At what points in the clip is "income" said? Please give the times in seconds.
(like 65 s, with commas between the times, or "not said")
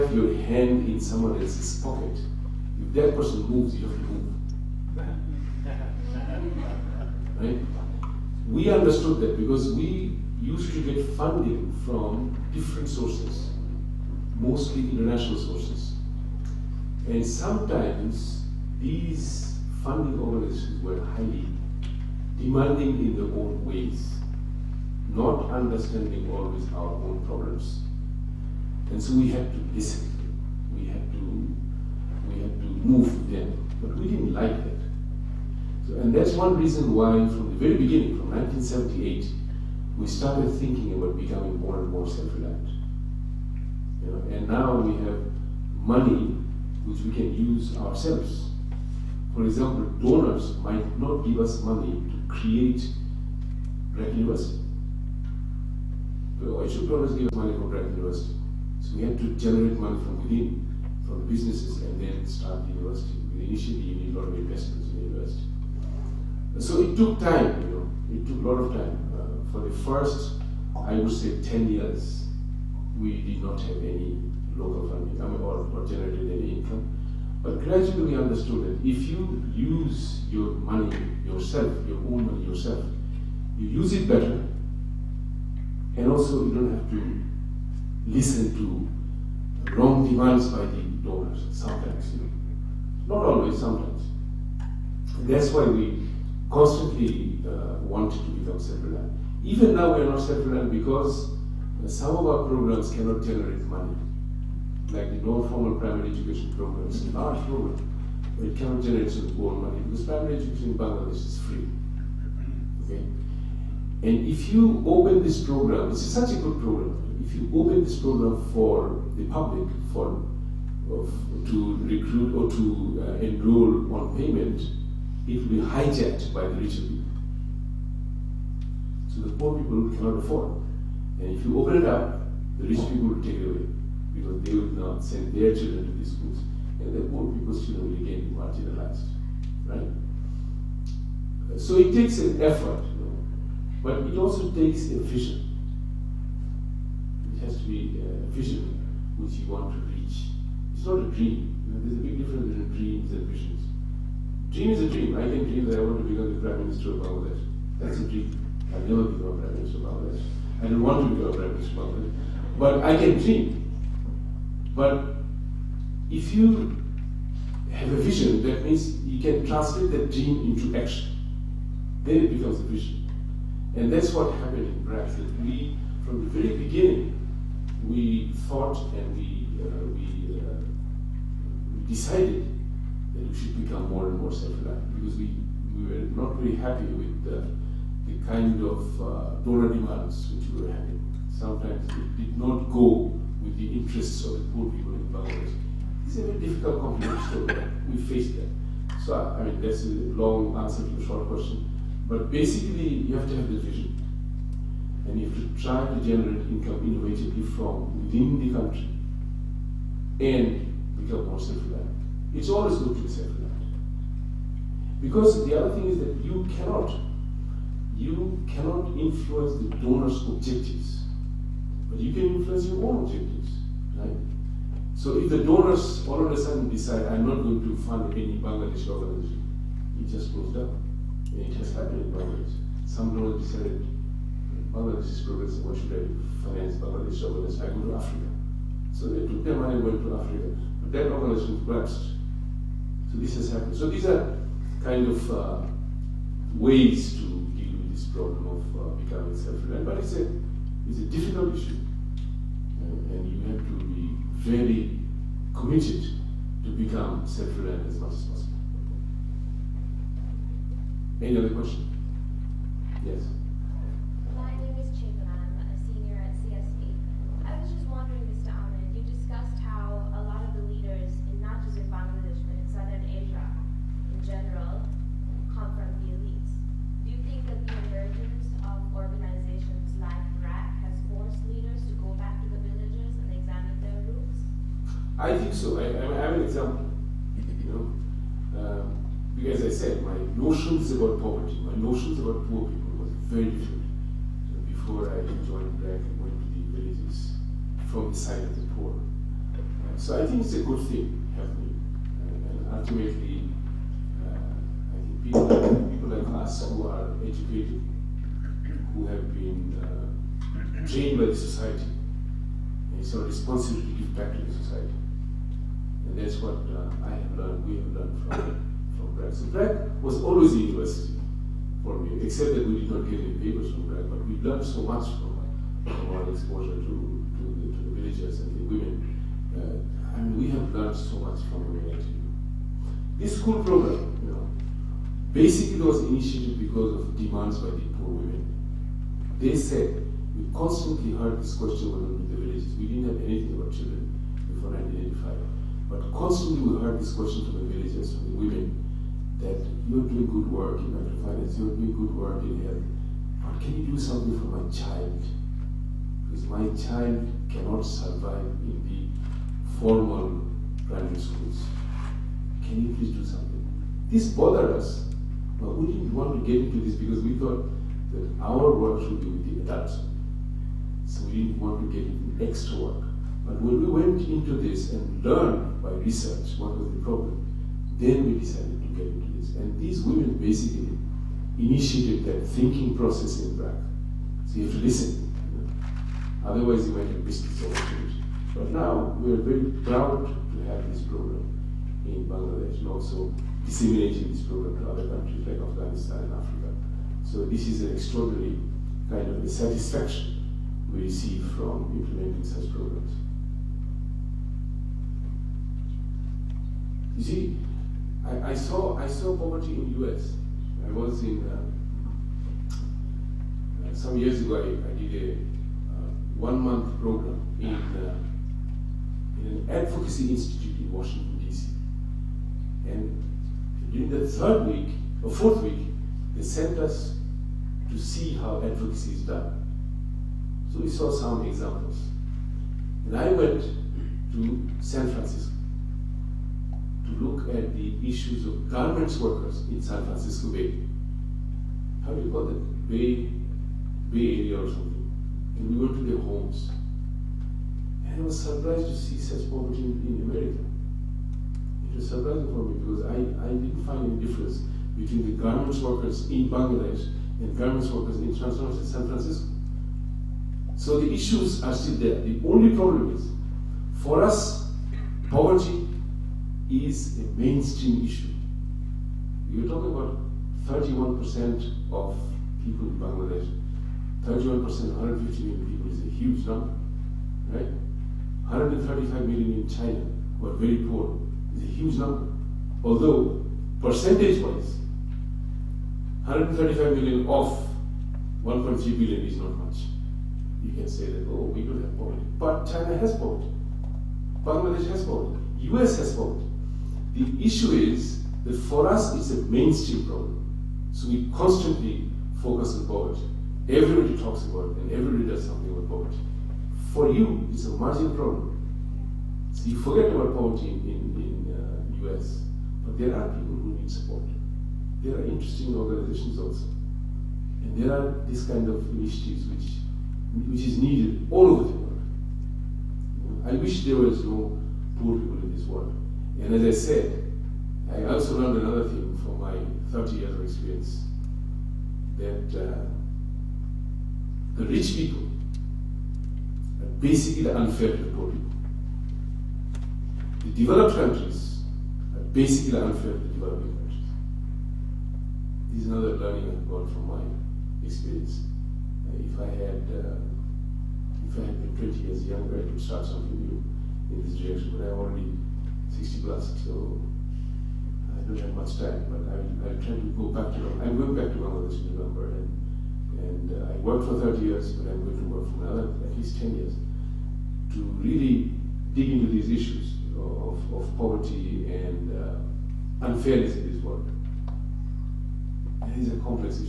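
76 s, 206 s.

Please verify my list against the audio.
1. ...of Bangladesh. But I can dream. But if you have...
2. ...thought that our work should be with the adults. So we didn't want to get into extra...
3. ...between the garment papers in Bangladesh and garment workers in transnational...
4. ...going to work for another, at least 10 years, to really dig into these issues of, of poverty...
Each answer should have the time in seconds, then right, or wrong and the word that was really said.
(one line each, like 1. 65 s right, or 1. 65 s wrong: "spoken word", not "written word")
1. 161 s right
2. 367 s right
3. 454 s wrong: "workers", not "papers"
4. 565 s right.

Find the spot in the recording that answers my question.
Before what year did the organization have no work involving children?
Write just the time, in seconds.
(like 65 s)
344 s.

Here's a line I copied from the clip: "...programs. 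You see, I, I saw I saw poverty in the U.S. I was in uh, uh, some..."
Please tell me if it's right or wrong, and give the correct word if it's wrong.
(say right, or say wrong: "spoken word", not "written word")
right.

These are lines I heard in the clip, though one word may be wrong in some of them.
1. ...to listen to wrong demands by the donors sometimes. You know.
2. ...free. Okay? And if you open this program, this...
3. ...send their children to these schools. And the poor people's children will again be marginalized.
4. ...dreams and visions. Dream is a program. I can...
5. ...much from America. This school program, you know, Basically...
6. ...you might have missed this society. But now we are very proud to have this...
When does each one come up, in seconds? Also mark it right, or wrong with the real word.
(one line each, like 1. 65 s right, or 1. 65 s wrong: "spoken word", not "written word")
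1. 86 s right
2. 111 s right
3. 135 s right
4. 152 s wrong: "dream", not "program"
5. 331 s right
6. 386 s wrong: "opportunity", not "society".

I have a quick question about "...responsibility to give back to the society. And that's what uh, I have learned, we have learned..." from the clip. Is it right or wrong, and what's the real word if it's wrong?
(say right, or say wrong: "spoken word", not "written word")
right.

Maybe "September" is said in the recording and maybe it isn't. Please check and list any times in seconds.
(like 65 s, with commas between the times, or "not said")
not said.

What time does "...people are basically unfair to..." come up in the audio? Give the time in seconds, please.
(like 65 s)
534 s.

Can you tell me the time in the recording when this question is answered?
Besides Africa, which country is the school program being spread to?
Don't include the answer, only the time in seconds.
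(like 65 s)
395 s.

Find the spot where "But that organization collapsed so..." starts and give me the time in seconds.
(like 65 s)
240 s.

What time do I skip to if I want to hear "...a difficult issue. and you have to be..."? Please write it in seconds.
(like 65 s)
250 s.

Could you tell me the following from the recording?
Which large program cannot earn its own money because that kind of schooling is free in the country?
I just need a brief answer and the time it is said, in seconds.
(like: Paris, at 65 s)
non-formal primary education, at 105 s.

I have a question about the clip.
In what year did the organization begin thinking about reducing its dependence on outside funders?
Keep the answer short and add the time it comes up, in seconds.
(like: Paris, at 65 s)
1978, at 38 s.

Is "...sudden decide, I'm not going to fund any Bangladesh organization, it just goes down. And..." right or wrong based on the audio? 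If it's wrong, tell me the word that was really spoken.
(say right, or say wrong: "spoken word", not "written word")
right.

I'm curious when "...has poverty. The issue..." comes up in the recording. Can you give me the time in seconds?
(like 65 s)
495 s.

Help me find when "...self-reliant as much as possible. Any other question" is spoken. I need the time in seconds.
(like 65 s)
257 s.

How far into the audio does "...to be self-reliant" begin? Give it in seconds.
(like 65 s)
212 s.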